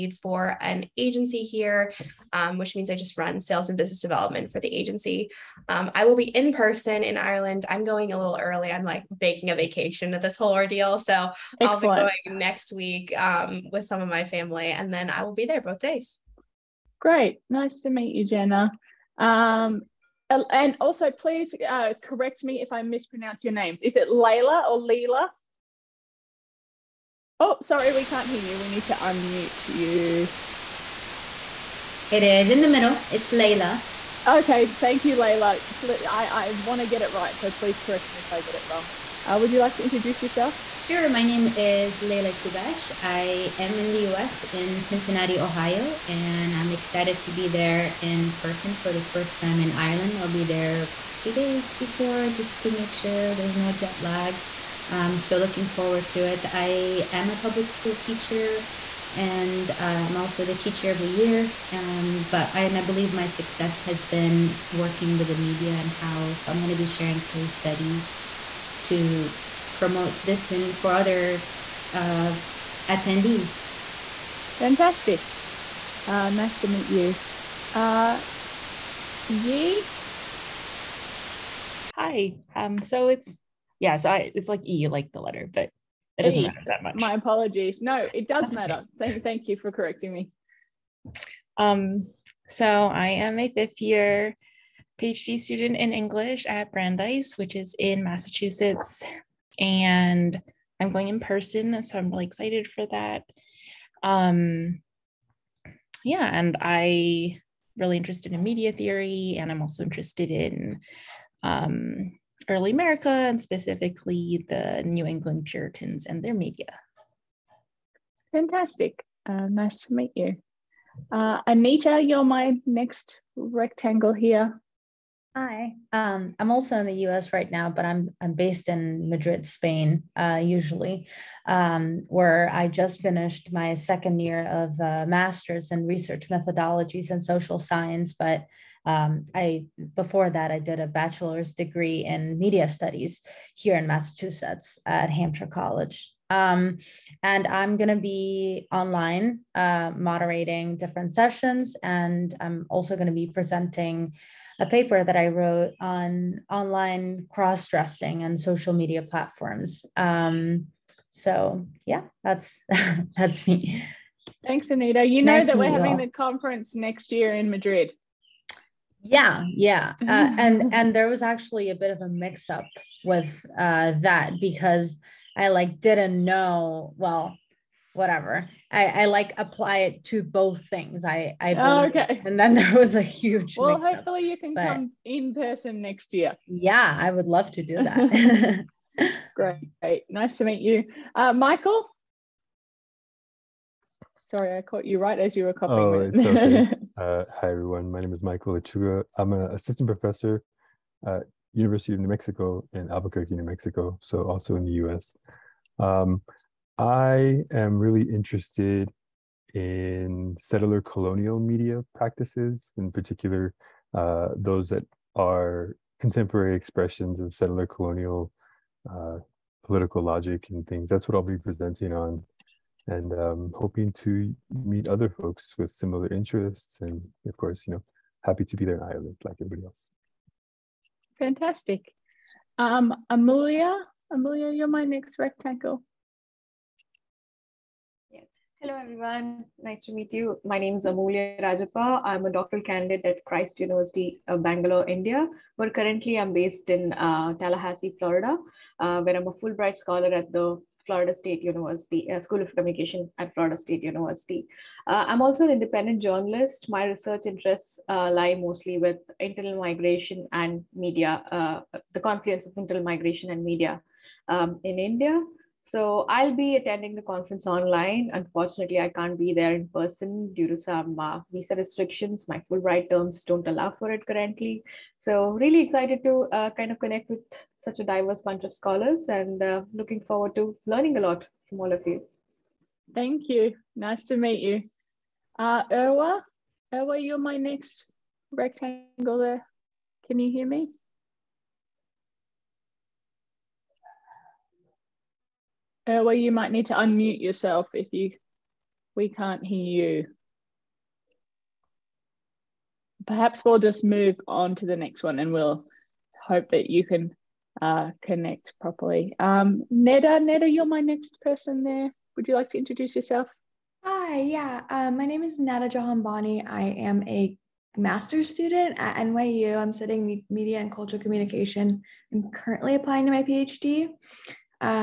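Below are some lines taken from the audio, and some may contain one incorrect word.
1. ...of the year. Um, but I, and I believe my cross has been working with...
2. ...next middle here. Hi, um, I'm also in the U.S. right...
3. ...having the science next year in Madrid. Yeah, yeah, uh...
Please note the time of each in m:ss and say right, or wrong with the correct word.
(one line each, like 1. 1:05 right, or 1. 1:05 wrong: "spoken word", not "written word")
1. 1:00 wrong: "success", not "cross"
2. 2:02 wrong: "rectangle", not "middle"
3. 2:45 wrong: "conference", not "science".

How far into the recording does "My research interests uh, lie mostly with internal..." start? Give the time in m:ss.
4:16.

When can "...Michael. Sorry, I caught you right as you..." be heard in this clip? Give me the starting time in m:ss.
3:11.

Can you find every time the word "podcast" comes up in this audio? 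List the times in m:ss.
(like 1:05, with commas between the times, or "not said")
not said.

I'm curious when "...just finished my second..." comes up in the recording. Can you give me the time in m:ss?
2:12.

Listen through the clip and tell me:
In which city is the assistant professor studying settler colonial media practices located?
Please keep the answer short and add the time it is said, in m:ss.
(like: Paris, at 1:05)
Albuquerque, at 3:22.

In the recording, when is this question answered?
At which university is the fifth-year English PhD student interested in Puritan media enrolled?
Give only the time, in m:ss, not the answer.
1:36.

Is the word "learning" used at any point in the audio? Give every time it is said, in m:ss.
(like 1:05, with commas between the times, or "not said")
4:40.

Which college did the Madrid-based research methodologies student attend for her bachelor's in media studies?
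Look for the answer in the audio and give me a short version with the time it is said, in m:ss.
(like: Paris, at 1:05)
Hampshire College, at 2:25.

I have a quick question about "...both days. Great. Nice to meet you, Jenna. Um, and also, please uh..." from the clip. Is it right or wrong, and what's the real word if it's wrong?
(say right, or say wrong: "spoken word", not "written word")
right.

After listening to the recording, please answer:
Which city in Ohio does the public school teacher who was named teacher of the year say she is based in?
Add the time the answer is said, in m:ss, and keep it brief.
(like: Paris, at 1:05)
Cincinnati, at 0:44.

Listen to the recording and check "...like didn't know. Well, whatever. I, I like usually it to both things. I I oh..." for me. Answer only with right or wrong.
wrong.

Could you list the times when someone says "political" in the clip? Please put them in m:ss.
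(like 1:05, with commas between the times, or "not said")
3:39.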